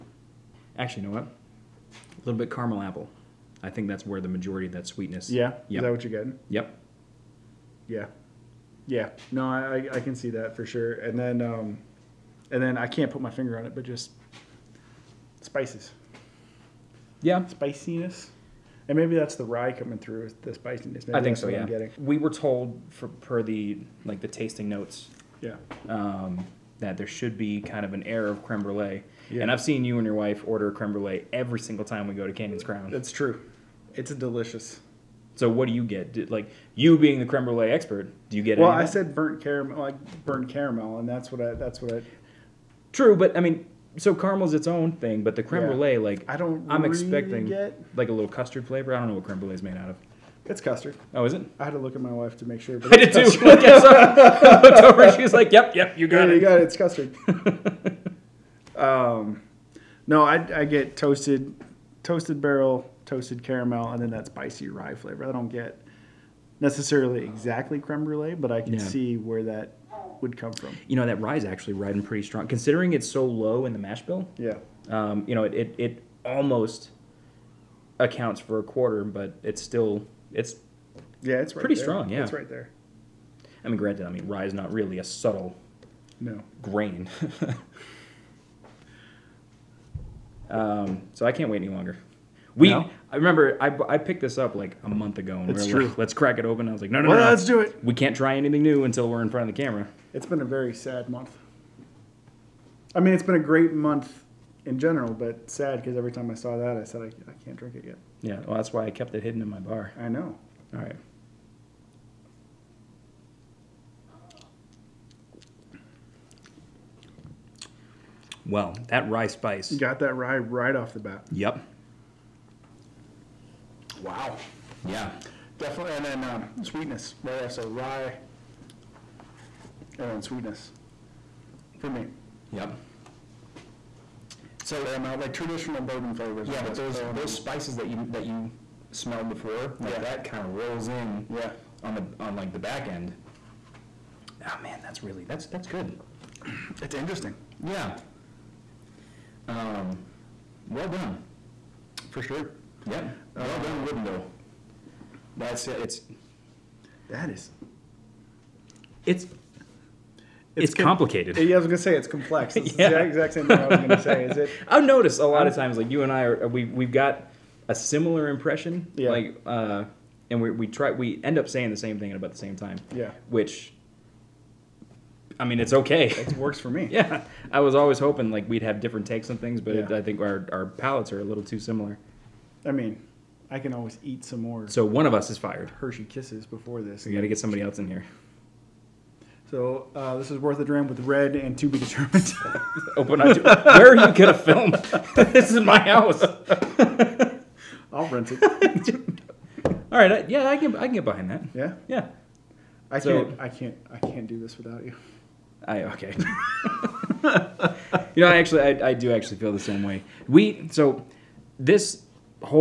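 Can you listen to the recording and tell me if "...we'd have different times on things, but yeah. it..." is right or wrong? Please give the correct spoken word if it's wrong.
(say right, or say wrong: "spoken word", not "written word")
wrong: "takes", not "times".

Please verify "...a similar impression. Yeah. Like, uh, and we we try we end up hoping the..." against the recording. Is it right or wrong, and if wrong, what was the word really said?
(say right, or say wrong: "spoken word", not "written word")
wrong: "saying", not "hoping".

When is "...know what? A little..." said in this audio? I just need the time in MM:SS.
00:01.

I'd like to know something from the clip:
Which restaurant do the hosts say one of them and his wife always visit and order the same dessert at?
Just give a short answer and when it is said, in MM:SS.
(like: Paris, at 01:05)
Canyon's Crown, at 00:32.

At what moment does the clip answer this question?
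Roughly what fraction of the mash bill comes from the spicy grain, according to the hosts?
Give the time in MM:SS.
01:18.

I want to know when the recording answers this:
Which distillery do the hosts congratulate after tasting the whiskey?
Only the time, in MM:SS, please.
02:33.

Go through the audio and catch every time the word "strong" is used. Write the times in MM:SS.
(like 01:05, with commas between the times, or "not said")
01:12, 01:21.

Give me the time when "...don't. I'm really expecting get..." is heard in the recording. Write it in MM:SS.
00:46.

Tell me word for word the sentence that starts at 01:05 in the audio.
I don't get necessarily exactly creme brulee, but I can yeah.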